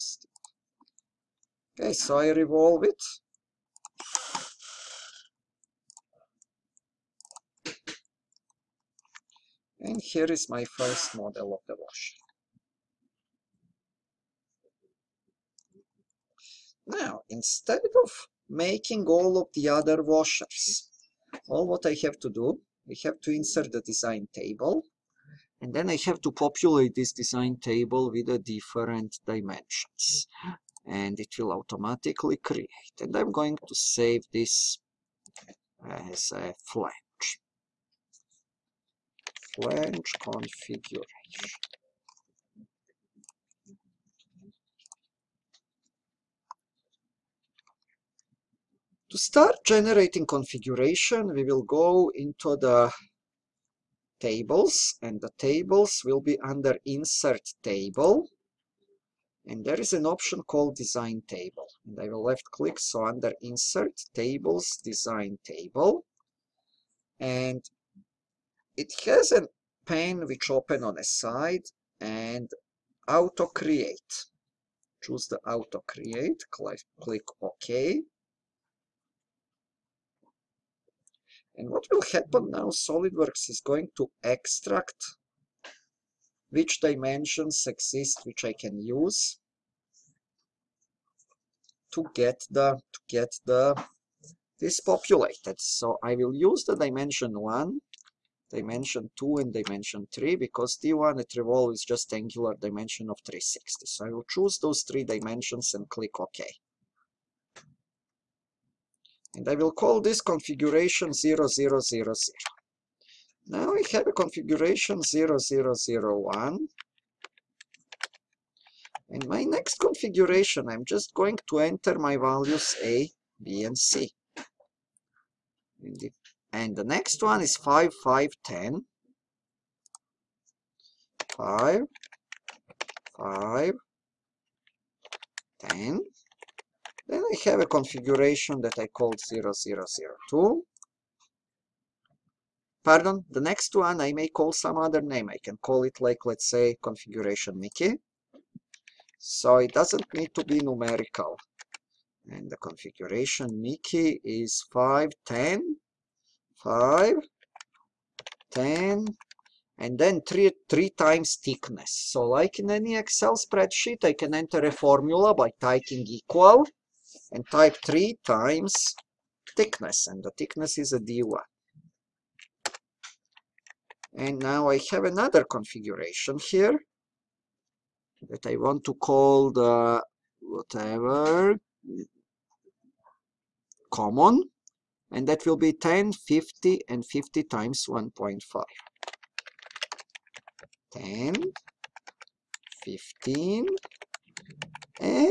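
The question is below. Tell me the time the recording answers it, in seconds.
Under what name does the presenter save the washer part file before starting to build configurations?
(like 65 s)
39 s.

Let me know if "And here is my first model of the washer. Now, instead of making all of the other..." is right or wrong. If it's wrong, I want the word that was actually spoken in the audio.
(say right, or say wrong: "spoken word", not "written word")
right.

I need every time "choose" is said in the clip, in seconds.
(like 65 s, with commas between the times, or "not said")
75 s, 104 s.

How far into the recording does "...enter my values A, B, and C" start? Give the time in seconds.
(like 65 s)
121 s.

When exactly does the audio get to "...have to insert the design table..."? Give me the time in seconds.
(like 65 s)
23 s.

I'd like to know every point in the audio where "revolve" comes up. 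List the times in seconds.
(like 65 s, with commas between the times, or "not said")
2 s, 101 s.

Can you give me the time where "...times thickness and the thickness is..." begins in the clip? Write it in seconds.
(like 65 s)
168 s.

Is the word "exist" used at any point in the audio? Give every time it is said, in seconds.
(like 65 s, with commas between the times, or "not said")
87 s.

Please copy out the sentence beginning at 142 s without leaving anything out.
Pardon, the next one I may call some other name.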